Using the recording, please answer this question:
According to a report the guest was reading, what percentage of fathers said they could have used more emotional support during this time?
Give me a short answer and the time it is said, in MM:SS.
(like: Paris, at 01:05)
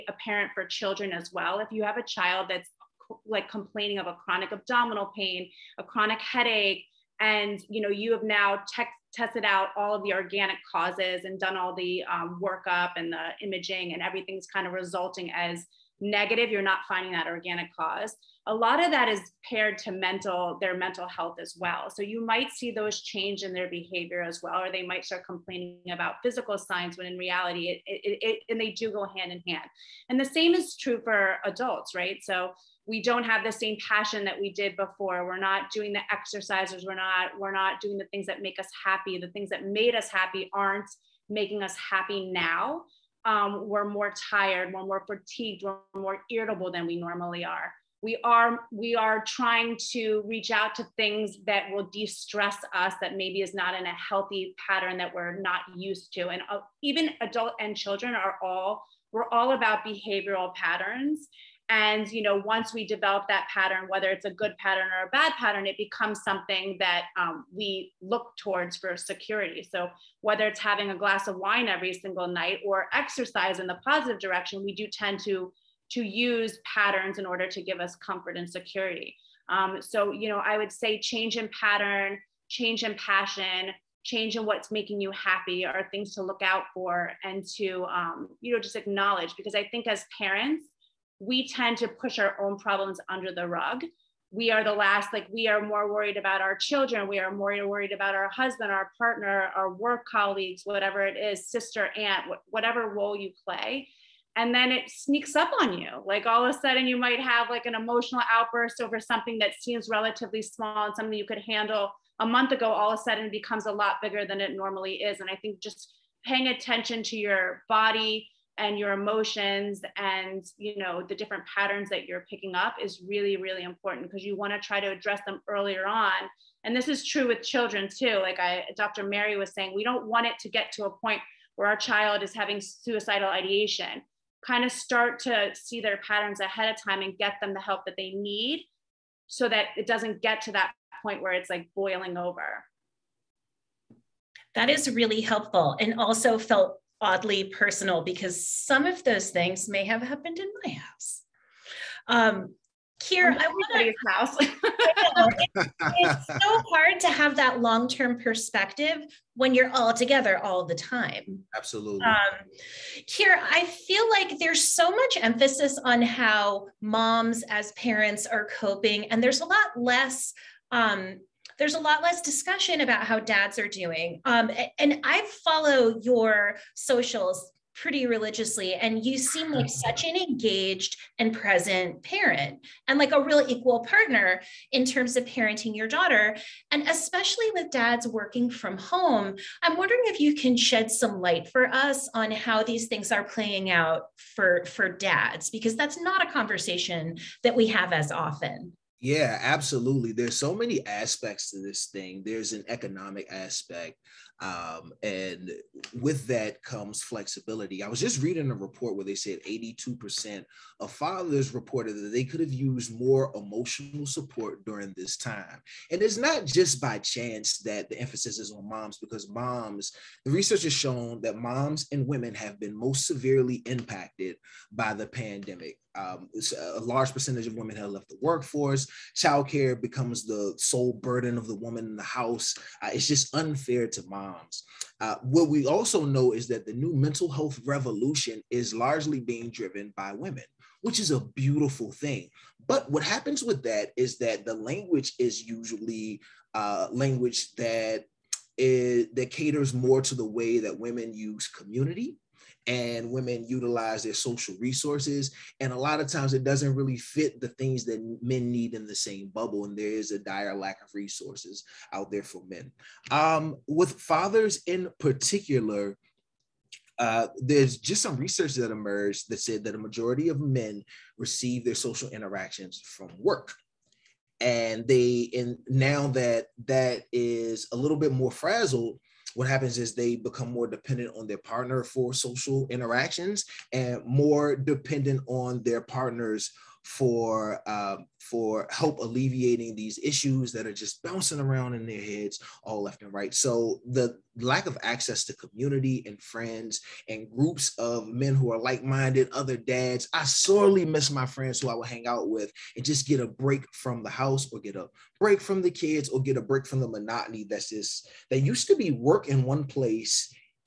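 82%, at 03:29.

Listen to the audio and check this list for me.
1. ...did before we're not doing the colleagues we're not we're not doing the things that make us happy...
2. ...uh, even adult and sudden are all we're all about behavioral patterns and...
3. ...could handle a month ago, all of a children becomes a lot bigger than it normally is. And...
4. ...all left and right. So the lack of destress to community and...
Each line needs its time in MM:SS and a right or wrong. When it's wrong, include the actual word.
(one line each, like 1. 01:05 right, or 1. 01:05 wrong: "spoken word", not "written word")
1. 00:34 wrong: "exercises", not "colleagues"
2. 00:56 wrong: "children", not "sudden"
3. 01:51 wrong: "sudden", not "children"
4. 04:52 wrong: "access", not "destress".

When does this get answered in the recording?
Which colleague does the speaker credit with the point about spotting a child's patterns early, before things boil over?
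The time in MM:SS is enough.
02:08.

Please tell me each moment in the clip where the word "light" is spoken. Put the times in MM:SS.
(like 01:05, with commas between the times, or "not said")
03:11.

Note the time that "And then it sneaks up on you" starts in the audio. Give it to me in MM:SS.
01:44.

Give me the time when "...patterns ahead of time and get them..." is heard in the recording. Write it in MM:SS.
02:16.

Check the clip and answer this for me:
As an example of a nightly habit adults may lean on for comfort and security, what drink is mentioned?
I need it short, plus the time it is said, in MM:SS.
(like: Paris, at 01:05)
a glass of wine, at 01:10.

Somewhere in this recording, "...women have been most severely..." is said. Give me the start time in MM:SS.
03:42.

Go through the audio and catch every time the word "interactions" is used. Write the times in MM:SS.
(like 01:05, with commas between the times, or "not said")
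04:32, 04:42.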